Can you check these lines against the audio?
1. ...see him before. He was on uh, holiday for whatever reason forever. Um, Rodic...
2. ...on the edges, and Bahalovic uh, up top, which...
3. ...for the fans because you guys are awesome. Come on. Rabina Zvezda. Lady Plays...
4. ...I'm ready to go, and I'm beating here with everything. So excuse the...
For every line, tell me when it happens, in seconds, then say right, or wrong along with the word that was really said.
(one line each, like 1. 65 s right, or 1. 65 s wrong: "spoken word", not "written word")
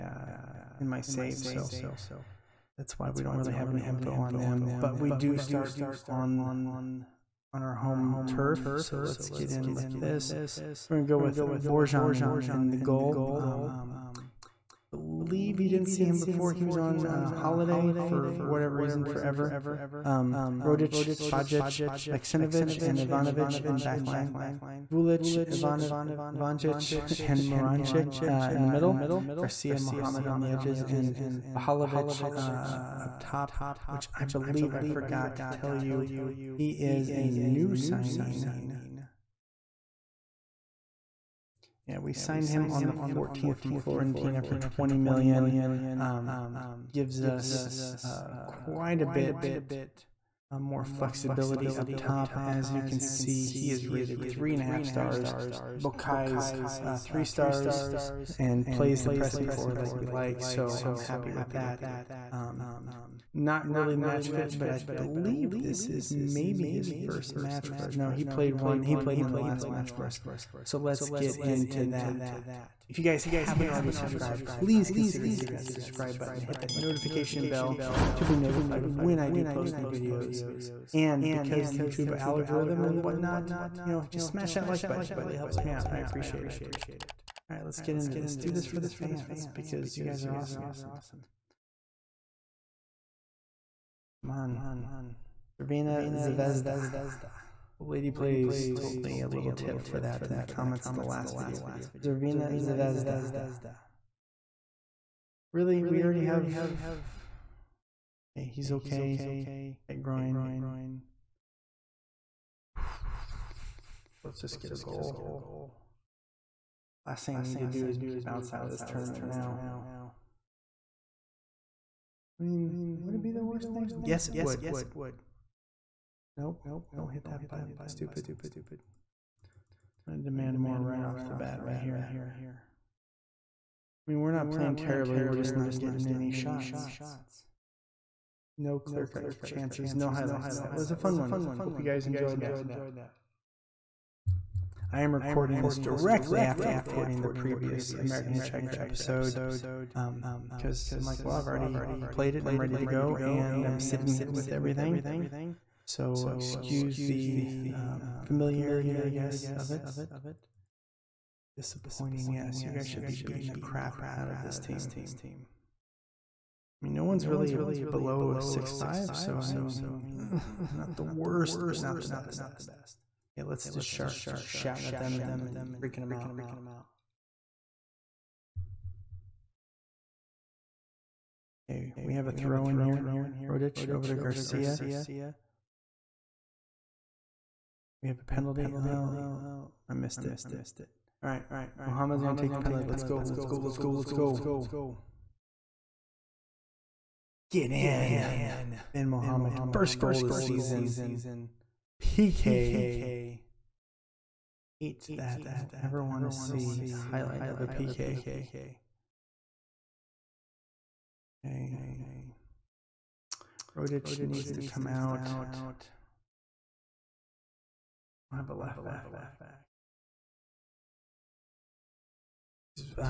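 1. 15 s right
2. 30 s right
3. 88 s right
4. 152 s wrong: "sitting", not "beating".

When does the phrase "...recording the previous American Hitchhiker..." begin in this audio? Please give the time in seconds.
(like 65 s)
146 s.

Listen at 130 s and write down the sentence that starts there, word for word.
I demand more right off the bat right here.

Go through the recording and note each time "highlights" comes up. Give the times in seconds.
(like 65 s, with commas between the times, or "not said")
140 s, 207 s.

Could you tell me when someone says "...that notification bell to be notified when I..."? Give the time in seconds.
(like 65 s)
76 s.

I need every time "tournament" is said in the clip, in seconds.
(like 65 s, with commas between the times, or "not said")
118 s.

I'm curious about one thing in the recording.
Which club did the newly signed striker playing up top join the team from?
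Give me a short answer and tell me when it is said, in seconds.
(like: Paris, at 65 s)
Fiorentina, at 43 s.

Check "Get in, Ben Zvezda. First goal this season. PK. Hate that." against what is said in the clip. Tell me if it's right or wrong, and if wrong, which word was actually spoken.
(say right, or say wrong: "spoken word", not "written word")
wrong: "Muhammad", not "Zvezda".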